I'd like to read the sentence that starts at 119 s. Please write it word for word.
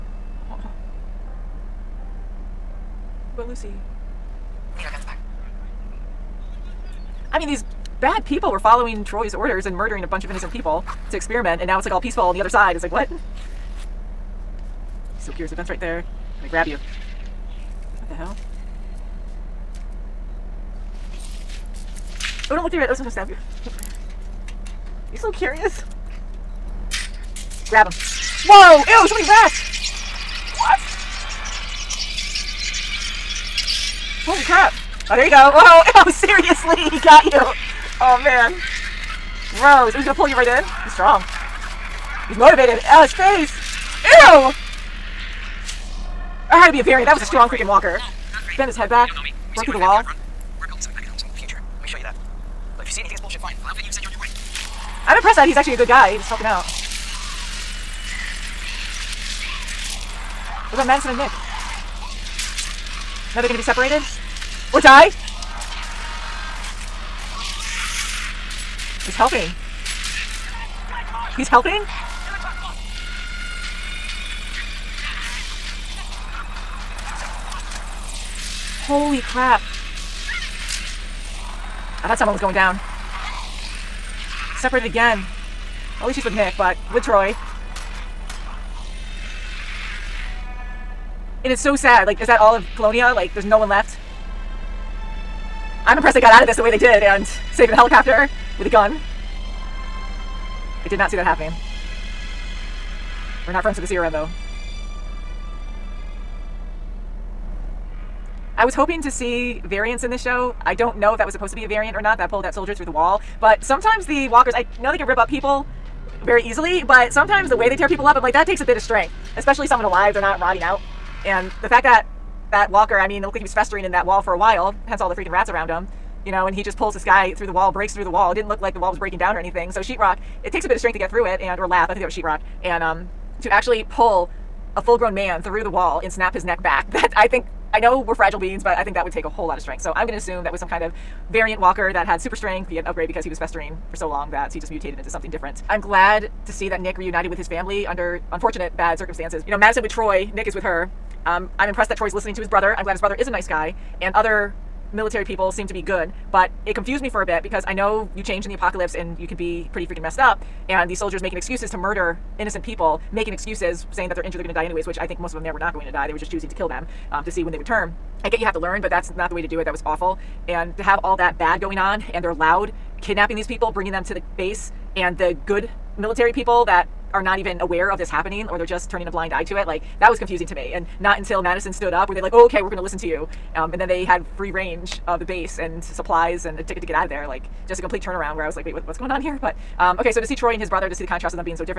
Especially someone alive, they're not rotting out.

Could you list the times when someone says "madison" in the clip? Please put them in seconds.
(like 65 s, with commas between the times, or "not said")
60 s, 149 s, 181 s.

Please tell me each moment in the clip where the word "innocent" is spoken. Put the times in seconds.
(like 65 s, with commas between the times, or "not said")
10 s, 162 s.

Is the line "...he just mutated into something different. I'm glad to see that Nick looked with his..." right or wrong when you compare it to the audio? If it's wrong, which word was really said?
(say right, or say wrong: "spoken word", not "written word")
wrong: "reunited", not "looked".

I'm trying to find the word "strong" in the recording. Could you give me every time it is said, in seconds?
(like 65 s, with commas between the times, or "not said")
40 s, 47 s.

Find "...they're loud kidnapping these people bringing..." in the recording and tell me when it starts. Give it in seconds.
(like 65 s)
172 s.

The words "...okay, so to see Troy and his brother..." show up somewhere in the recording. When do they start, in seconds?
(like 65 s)
189 s.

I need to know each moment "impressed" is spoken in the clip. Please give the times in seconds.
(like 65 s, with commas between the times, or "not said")
55 s, 95 s, 151 s.